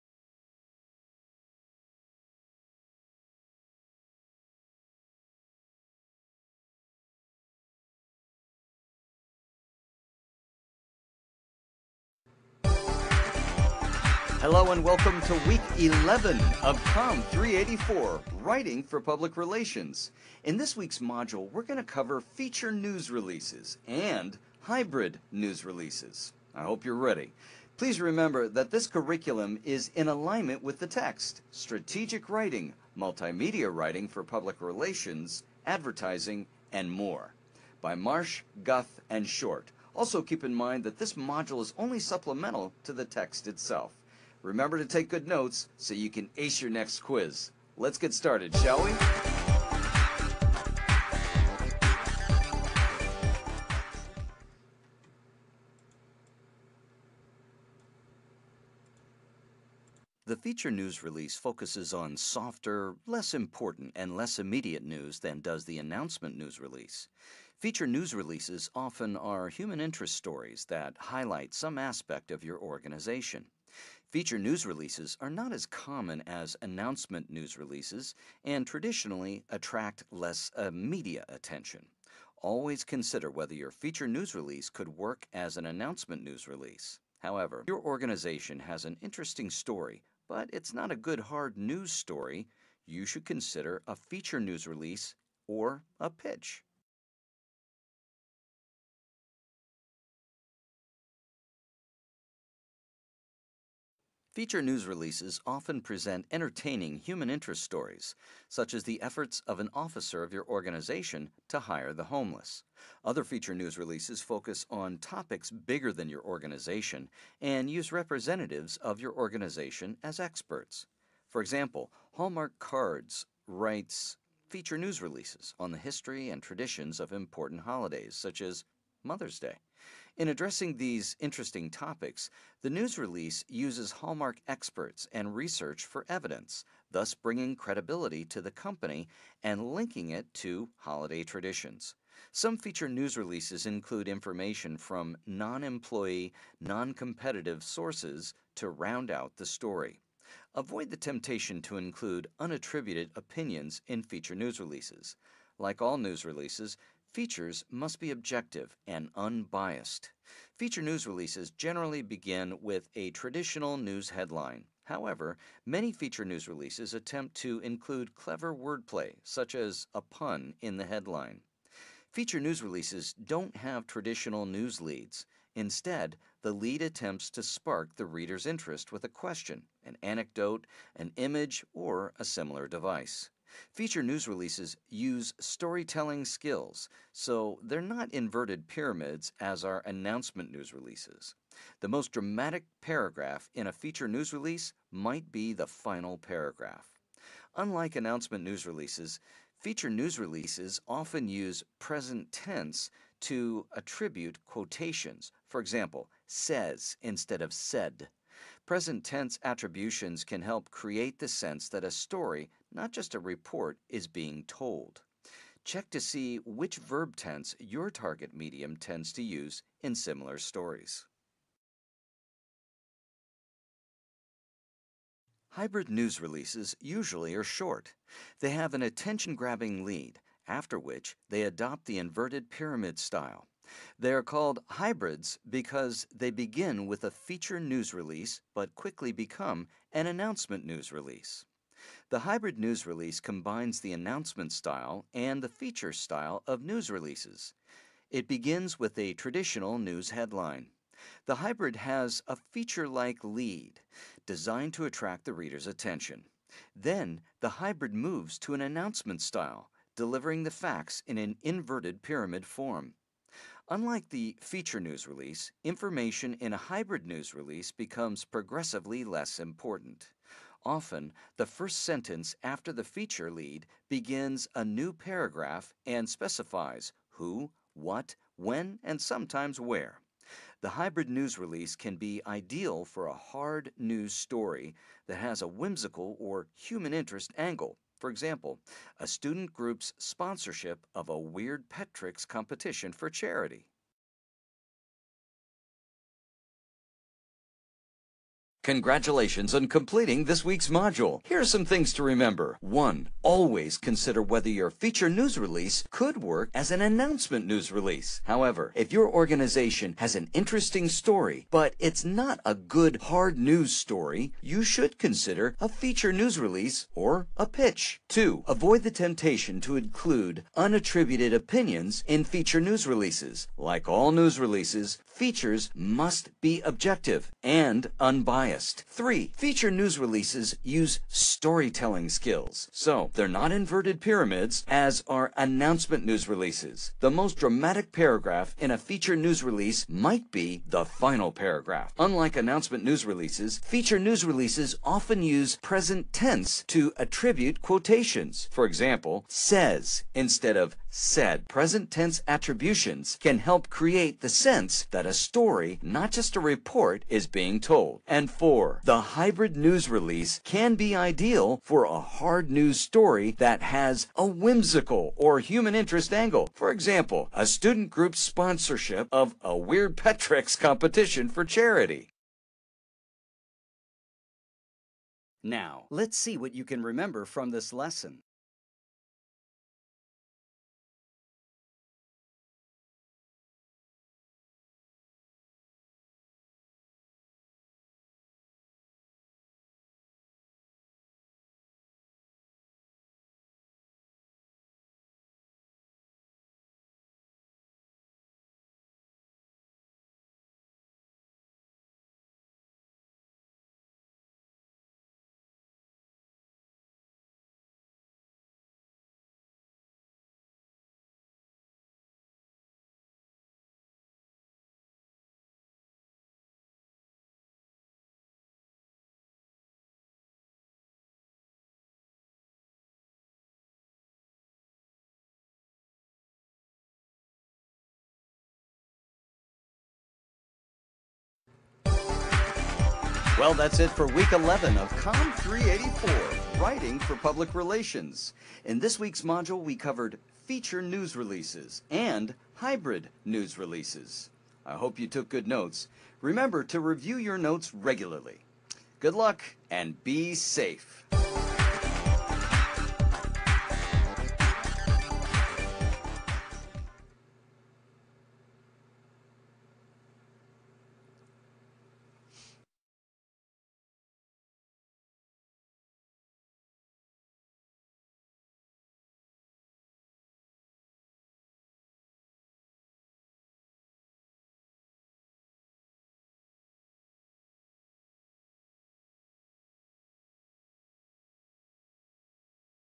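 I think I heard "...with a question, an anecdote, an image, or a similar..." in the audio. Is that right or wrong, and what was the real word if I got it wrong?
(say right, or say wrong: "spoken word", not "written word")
right.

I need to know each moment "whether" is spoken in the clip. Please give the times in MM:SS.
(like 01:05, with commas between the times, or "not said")
01:23, 05:04.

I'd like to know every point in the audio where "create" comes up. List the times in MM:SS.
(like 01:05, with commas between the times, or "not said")
03:30, 05:53.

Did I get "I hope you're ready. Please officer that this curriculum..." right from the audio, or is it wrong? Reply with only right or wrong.
wrong.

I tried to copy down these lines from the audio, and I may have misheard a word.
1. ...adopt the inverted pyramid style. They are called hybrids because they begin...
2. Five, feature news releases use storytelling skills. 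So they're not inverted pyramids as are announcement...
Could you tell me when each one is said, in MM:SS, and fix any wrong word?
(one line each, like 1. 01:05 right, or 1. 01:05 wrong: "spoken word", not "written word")
1. 03:51 right
2. 05:28 wrong: "Three", not "Five".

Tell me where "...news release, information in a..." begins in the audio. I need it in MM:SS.
04:24.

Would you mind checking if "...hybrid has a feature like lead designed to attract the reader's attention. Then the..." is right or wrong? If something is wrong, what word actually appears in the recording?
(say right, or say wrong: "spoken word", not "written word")
right.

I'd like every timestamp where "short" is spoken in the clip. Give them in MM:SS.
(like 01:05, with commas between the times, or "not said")
00:39, 03:47.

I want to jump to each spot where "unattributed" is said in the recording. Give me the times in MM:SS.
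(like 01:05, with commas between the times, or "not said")
02:32, 05:20.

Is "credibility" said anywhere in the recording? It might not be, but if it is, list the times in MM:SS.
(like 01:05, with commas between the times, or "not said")
02:17.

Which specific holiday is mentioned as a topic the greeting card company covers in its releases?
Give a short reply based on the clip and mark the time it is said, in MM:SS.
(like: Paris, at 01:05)
Mother's Day, at 02:09.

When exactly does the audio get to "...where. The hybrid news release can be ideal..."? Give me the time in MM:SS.
04:39.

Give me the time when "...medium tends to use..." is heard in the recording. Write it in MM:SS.
03:38.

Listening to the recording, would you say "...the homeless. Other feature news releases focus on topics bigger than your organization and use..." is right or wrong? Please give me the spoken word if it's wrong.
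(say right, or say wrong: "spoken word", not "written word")
right.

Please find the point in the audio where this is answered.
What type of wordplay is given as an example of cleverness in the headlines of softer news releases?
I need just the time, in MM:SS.
02:49.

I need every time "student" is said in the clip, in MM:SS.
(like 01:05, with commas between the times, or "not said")
04:49, 06:07.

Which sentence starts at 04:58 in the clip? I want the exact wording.
Congratulations on completing this week's module.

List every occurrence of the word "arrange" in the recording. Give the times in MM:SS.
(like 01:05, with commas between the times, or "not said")
not said.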